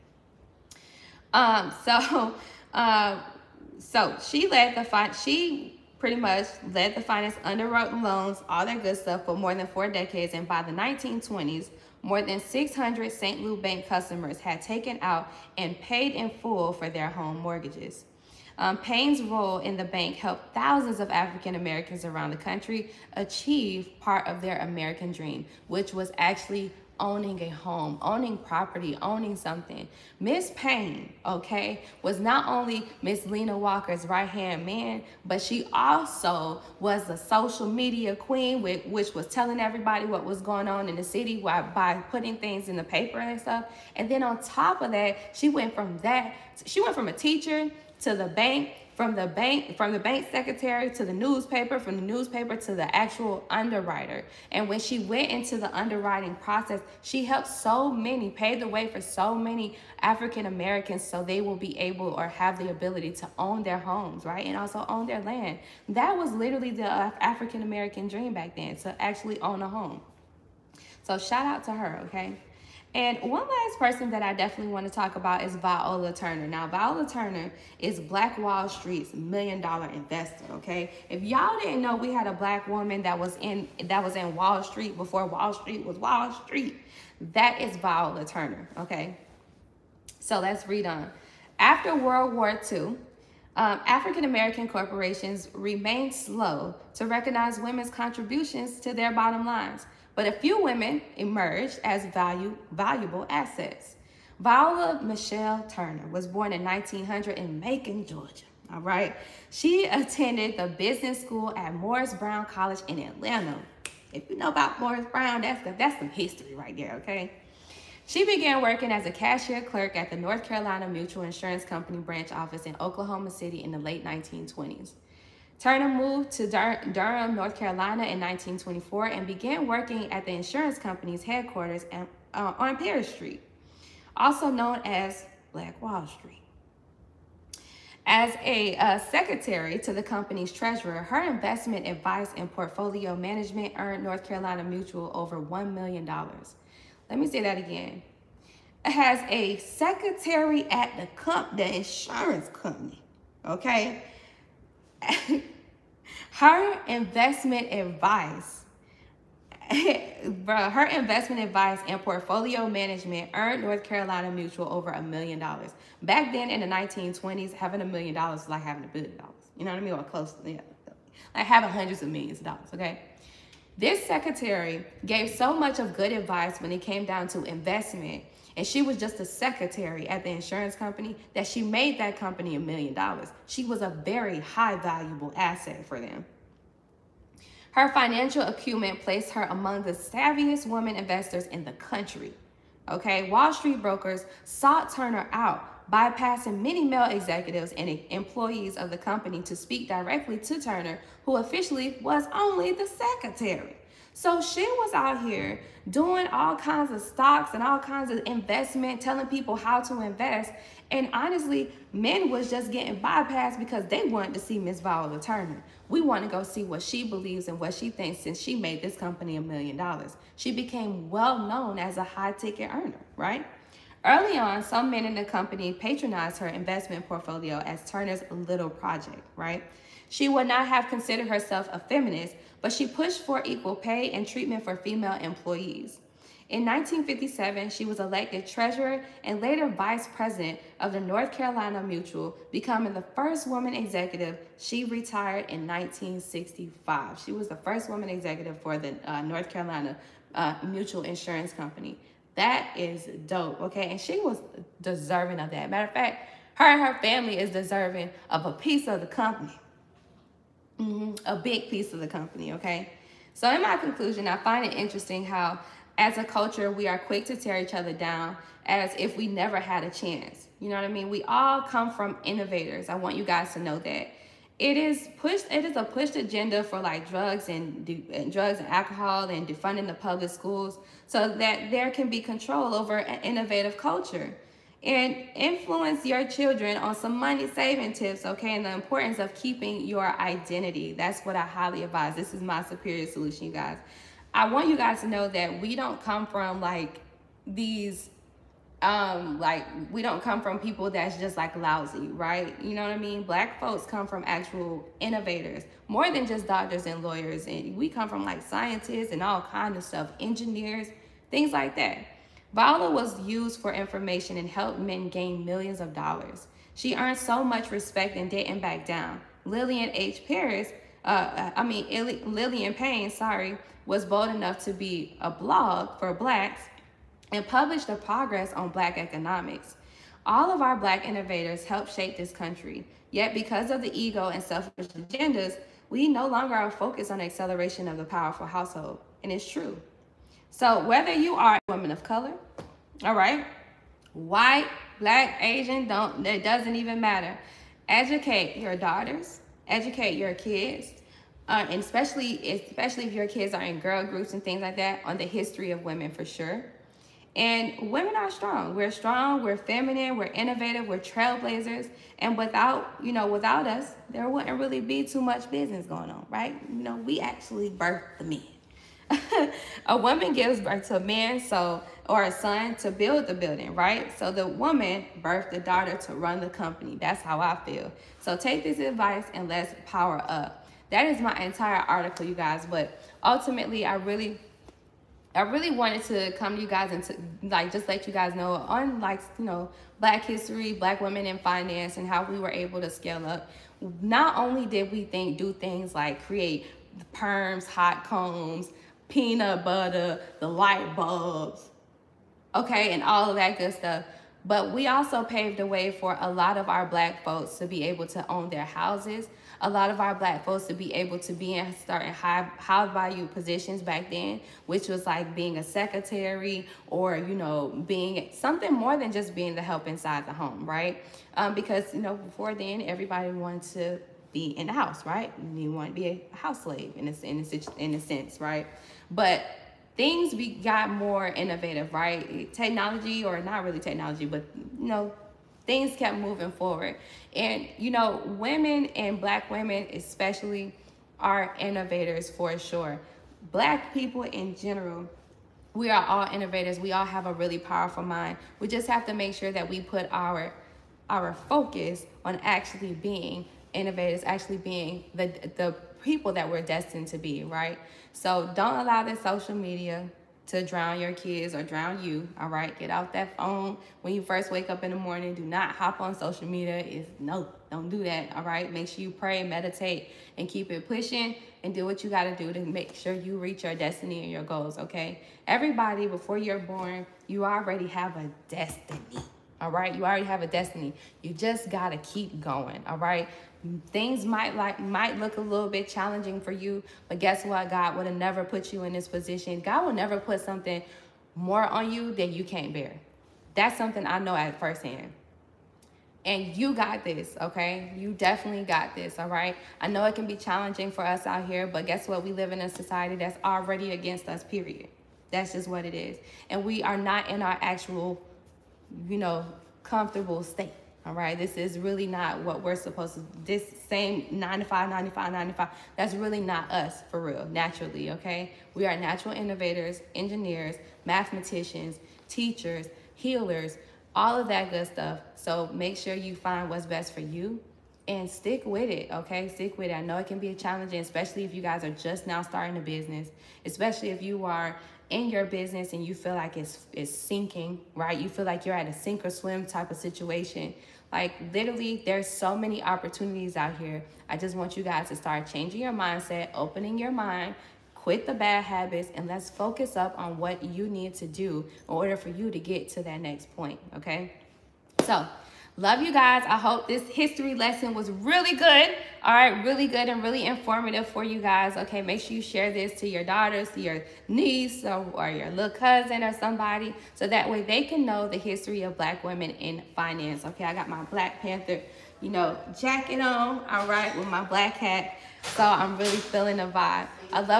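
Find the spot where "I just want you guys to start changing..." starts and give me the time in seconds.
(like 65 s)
544 s.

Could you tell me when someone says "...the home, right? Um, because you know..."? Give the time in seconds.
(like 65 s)
420 s.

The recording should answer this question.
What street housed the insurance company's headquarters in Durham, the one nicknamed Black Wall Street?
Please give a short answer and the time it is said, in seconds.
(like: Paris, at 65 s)
Perry Street, at 132 s.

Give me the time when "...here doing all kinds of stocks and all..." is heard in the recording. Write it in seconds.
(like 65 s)
205 s.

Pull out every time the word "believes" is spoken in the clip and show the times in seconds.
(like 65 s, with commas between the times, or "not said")
217 s.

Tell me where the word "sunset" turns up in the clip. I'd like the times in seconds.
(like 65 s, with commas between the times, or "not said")
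not said.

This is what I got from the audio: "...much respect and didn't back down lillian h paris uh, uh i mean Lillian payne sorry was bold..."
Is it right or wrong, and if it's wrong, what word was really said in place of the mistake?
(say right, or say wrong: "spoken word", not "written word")
right.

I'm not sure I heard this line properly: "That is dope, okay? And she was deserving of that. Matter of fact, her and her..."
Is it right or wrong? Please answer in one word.
right.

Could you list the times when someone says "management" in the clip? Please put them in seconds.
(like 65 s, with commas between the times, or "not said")
143 s, 162 s.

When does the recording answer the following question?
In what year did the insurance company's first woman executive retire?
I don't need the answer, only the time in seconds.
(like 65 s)
245 s.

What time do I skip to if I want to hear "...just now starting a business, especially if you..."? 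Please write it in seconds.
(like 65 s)
531 s.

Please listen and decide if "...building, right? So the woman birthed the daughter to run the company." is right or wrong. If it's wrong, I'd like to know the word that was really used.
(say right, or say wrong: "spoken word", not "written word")
right.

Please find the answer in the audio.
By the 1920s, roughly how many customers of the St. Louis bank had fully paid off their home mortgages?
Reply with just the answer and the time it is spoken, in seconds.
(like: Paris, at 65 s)
600, at 12 s.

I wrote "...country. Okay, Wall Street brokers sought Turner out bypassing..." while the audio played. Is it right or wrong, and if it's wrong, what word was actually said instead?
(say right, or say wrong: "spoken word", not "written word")
right.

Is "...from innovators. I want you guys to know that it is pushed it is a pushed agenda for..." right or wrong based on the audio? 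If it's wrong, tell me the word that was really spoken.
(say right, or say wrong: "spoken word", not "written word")
right.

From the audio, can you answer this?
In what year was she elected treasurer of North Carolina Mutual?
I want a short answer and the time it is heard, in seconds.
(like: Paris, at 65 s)
1957, at 236 s.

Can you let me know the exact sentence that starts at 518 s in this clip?
We are natural innovators, engineers, mathematicians, teachers, healers, all of that good stuff.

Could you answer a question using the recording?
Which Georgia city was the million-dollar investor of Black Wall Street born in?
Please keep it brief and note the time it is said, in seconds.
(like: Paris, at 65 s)
Macon, Georgia, at 107 s.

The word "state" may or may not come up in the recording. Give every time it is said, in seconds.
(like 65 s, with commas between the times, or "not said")
510 s.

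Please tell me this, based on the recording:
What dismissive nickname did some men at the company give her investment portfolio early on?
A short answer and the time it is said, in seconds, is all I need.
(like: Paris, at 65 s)
Turner's little project, at 227 s.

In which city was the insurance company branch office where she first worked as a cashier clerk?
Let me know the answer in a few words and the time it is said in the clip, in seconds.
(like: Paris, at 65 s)
Oklahoma City, at 122 s.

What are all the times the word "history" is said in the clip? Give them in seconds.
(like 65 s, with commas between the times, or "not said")
116 s, 355 s, 390 s, 557 s, 568 s.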